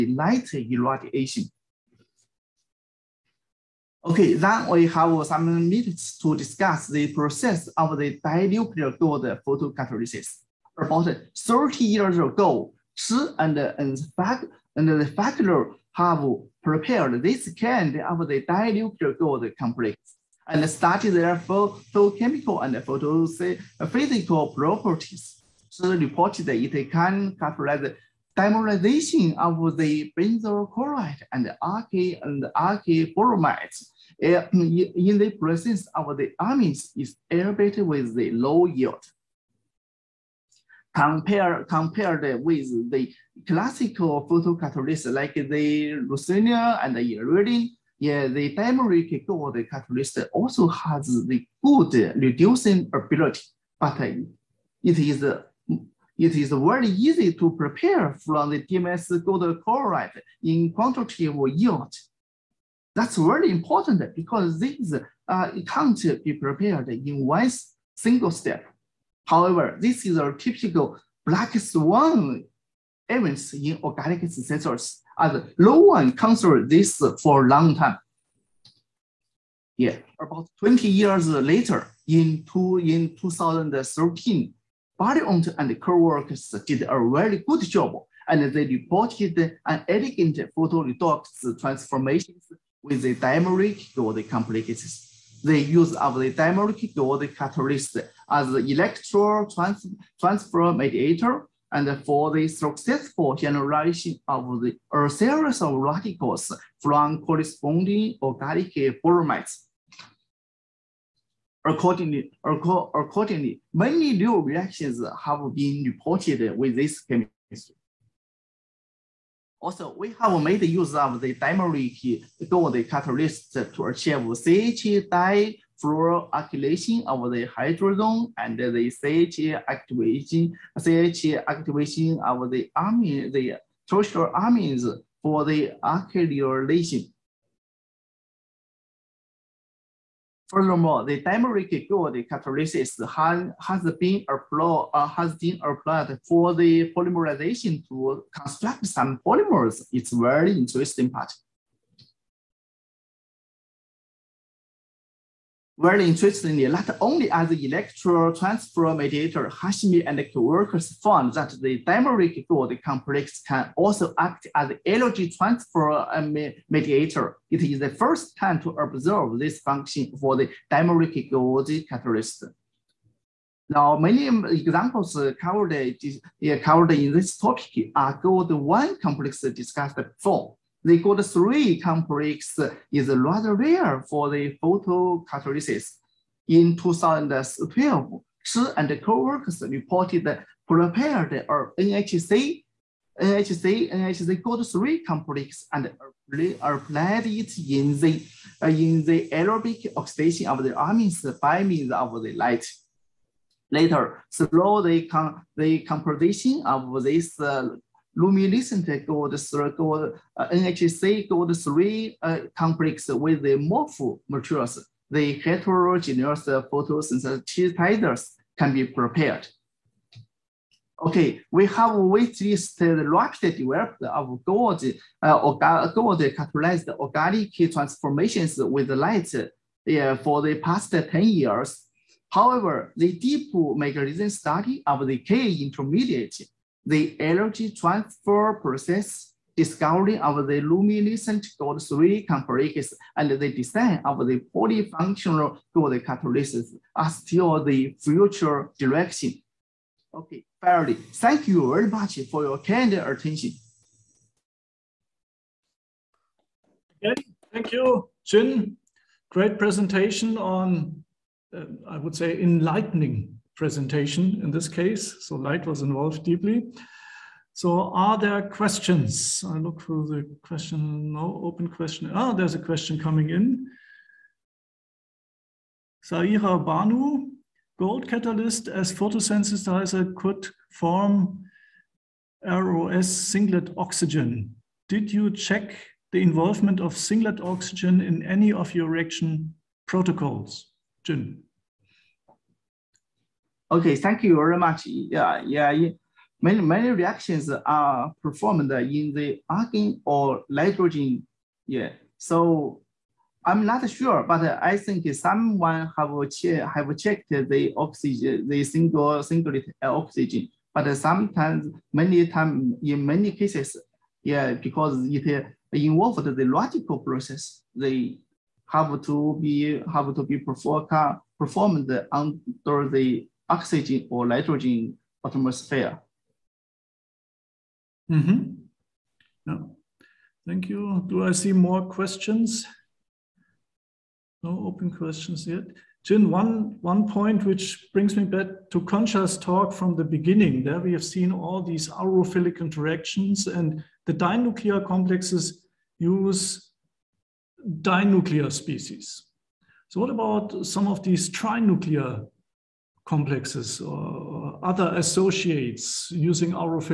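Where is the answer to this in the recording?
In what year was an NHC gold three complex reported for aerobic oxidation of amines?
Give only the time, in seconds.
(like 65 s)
186 s.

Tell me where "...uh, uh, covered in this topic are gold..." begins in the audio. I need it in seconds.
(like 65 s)
175 s.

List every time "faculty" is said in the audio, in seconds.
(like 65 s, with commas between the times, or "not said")
15 s.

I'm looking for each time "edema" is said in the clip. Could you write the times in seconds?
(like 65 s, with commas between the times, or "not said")
not said.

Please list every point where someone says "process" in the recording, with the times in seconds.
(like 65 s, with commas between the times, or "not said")
7 s, 238 s, 316 s.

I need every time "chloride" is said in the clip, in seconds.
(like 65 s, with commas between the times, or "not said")
30 s, 59 s.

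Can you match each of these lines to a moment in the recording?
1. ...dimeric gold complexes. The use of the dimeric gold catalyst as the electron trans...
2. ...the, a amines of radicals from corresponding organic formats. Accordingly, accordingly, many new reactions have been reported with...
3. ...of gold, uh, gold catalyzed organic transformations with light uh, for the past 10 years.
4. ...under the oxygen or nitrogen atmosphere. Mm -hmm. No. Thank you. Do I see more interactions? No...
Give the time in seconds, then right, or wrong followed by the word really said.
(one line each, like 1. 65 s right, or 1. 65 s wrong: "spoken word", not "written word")
1. 93 s right
2. 104 s wrong: "series", not "amines"
3. 224 s right
4. 322 s wrong: "questions", not "interactions".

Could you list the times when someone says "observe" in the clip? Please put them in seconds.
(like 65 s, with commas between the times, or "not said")
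168 s.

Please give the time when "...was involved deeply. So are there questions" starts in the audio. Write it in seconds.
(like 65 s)
265 s.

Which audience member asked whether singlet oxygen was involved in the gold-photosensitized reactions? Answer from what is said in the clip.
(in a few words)
Saira Banu.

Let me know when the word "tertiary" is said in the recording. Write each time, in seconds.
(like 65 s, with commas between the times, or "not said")
133 s.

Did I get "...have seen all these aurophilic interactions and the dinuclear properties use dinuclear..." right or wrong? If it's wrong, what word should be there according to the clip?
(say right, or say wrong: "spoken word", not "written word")
wrong: "complexes", not "properties".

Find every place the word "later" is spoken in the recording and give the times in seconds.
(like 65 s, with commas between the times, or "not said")
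81 s, 203 s.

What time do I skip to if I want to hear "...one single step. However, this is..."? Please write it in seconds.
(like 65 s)
67 s.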